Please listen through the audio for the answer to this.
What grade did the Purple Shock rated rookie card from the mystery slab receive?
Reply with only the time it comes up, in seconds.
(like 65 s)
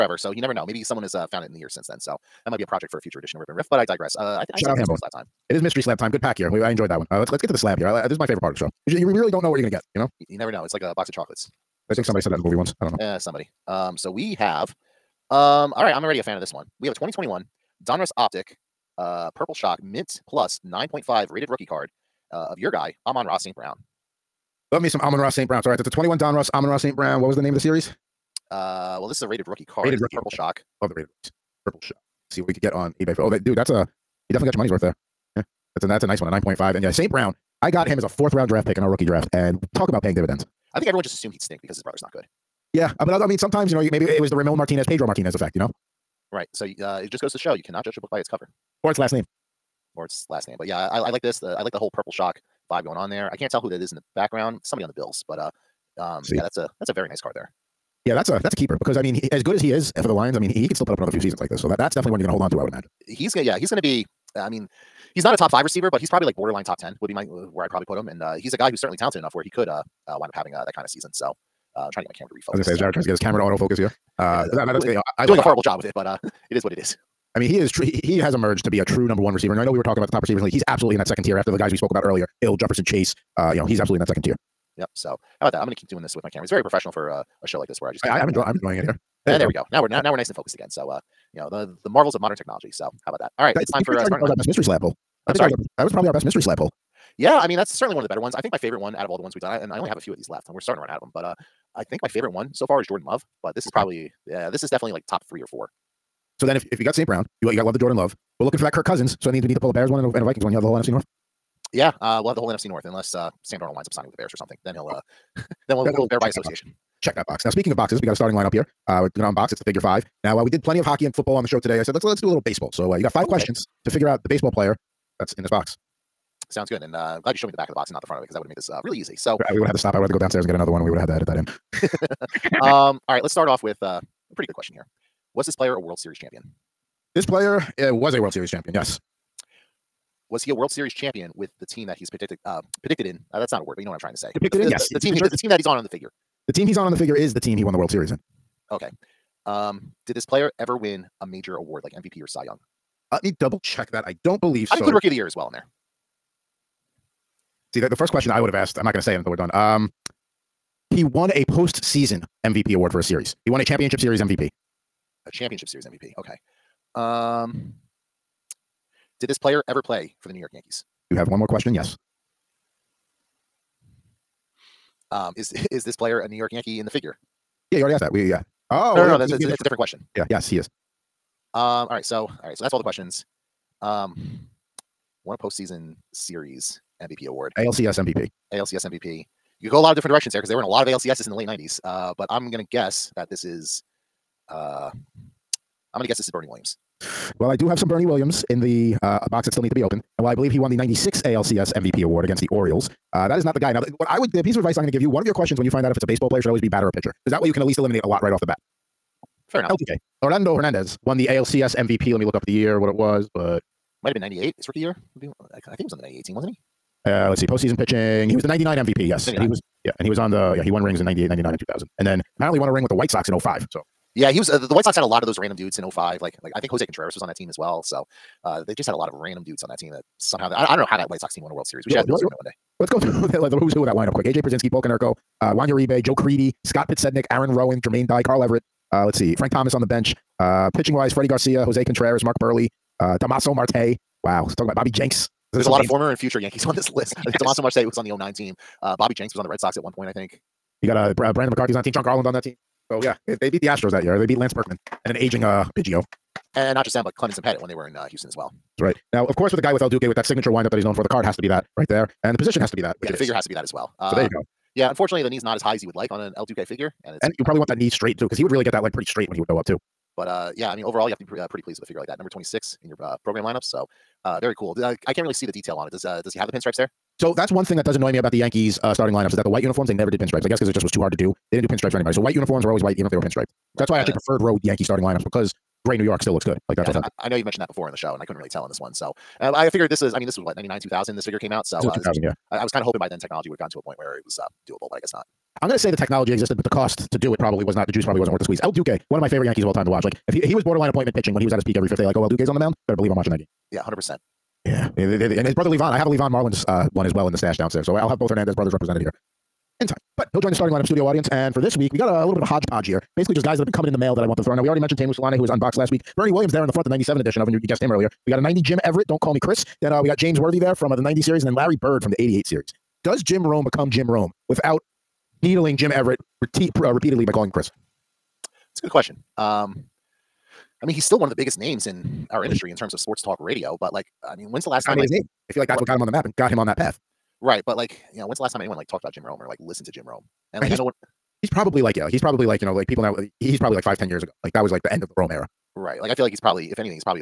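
19 s.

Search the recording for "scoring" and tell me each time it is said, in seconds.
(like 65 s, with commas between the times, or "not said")
not said.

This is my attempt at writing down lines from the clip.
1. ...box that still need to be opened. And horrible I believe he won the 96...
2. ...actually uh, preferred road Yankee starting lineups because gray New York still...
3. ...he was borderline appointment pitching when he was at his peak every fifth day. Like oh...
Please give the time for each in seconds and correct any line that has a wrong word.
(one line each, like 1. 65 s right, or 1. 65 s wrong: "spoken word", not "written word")
1. 199 s wrong: "while", not "horrible"
2. 283 s right
3. 300 s right.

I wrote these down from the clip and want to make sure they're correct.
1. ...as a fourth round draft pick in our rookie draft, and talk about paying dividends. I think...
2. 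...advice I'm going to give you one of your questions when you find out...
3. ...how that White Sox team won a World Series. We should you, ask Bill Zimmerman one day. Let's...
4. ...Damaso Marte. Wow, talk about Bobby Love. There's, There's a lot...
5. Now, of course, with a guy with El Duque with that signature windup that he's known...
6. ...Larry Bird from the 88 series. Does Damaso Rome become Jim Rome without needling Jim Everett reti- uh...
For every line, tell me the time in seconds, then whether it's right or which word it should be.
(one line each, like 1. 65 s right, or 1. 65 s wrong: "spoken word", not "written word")
1. 37 s right
2. 204 s right
3. 230 s right
4. 243 s wrong: "Jenks", not "Love"
5. 259 s right
6. 321 s wrong: "Jim", not "Damaso".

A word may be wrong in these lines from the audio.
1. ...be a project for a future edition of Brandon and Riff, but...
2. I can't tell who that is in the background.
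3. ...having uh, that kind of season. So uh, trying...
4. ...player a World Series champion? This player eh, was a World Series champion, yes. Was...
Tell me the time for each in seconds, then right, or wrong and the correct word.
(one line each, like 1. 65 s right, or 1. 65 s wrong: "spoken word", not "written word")
1. 2 s wrong: "Rip", not "Brandon"
2. 53 s right
3. 70 s right
4. 135 s right.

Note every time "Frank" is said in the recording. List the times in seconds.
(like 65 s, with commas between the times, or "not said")
239 s.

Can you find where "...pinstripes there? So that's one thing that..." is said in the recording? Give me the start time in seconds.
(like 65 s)
276 s.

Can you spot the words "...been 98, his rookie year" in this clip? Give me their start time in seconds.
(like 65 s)
214 s.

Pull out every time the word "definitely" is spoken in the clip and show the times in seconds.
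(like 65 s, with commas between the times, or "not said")
34 s, 61 s, 104 s.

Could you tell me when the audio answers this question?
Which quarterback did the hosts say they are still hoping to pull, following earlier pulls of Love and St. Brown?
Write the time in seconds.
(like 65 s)
108 s.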